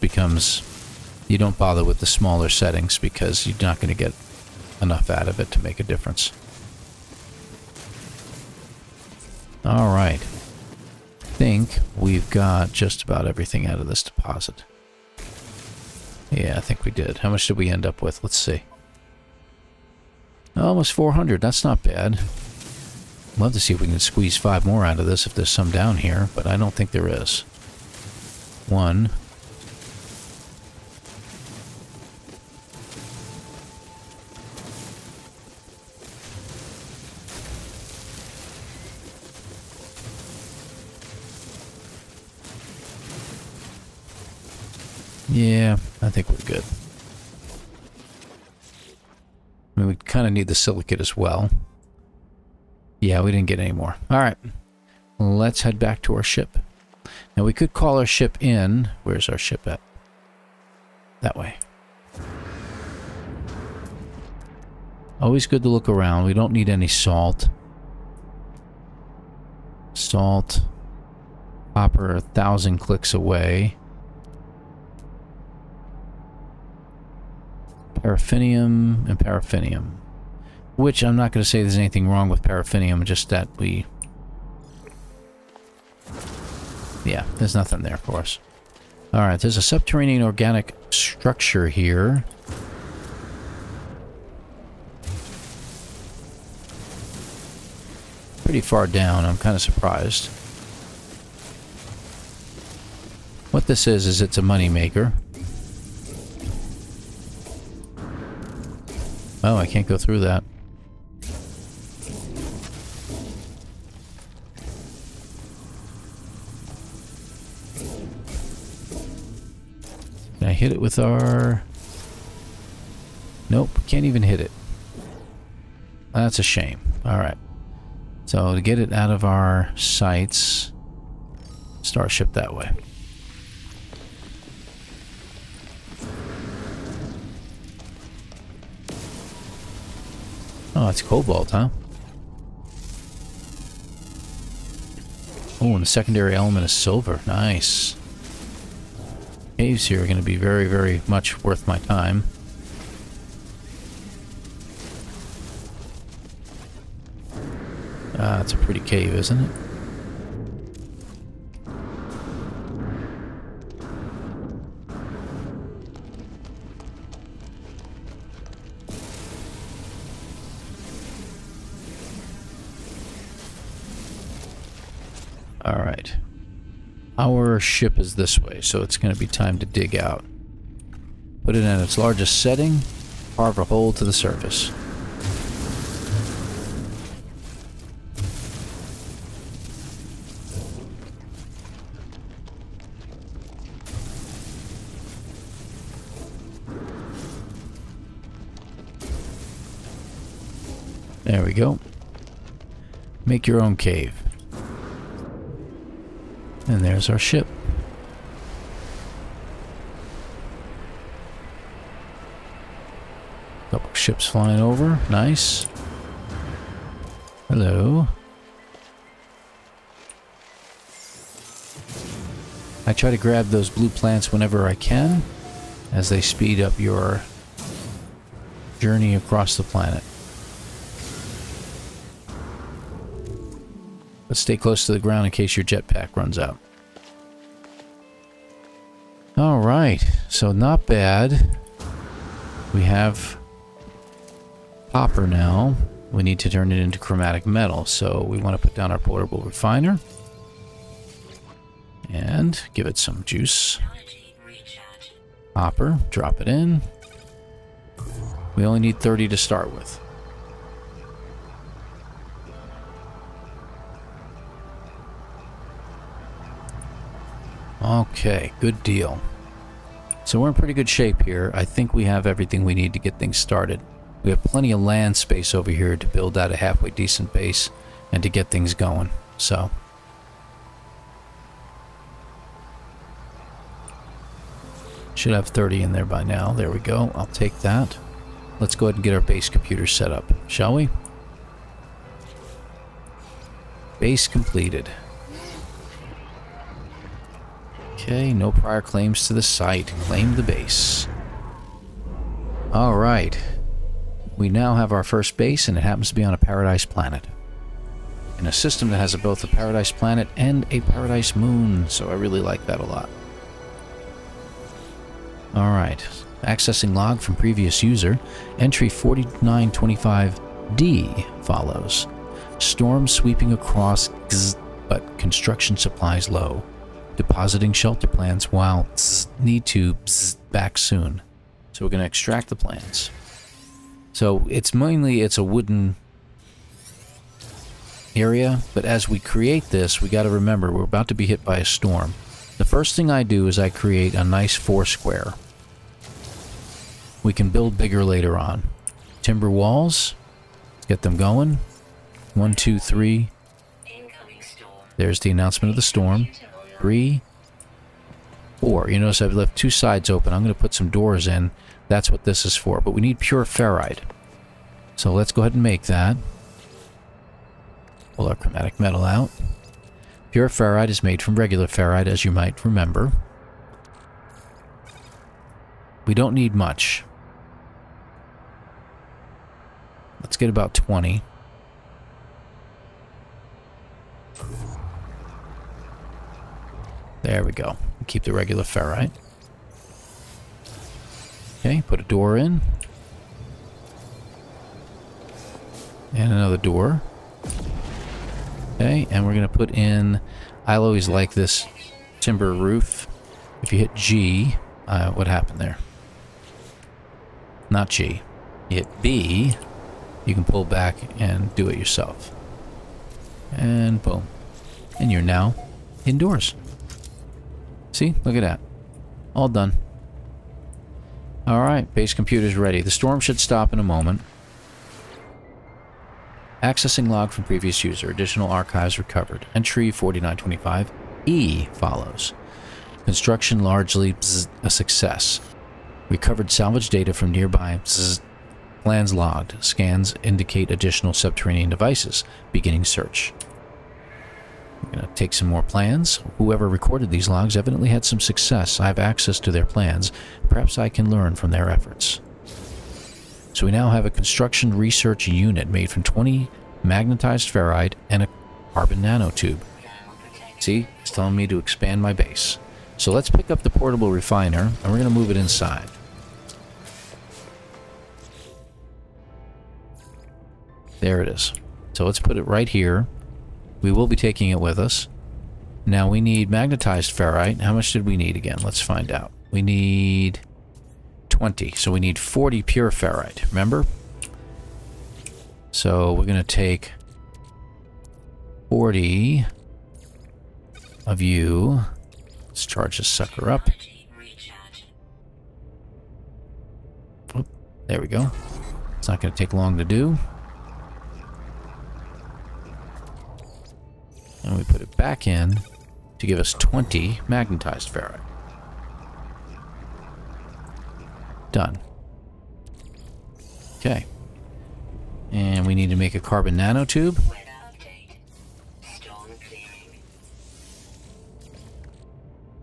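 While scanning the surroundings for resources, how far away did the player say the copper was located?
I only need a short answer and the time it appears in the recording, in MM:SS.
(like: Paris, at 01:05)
A thousand clicks, at 01:12.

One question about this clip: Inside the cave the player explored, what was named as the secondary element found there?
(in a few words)
Silver.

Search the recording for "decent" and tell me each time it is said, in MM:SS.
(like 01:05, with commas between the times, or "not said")
04:36.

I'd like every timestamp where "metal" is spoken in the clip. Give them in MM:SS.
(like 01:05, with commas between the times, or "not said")
04:07, 06:08.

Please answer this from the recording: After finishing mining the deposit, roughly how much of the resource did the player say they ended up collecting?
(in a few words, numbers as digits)
Almost 400.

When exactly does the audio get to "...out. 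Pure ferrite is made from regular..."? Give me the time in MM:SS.
06:09.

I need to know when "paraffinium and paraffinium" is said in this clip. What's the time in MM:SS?
01:18.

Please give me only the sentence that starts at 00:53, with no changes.
Yeah, we didn't get any more.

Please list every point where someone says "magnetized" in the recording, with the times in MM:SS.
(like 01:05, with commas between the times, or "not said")
07:36, 07:56, 08:27.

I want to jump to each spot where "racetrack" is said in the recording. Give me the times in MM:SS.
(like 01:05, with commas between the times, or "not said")
not said.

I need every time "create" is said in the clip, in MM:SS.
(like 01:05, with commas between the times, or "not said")
05:39, 05:43.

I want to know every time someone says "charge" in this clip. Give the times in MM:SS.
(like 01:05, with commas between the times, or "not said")
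08:12.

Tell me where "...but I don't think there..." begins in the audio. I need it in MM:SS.
00:26.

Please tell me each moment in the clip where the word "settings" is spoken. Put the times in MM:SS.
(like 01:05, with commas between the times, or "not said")
00:02, 03:02.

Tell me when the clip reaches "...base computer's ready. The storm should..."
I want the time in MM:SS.
07:01.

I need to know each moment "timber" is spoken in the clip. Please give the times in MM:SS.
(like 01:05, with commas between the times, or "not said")
05:49, 06:42.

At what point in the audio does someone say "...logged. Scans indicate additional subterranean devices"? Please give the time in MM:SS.
07:19.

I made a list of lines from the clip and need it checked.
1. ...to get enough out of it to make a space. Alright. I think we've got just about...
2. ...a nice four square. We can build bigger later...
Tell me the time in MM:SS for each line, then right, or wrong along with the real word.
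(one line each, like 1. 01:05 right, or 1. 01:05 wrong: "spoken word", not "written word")
1. 00:03 wrong: "difference", not "space"
2. 05:44 right.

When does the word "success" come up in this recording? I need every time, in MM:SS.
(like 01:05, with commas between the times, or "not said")
07:14, 07:28.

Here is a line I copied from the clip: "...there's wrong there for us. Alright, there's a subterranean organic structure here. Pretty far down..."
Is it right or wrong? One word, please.
wrong.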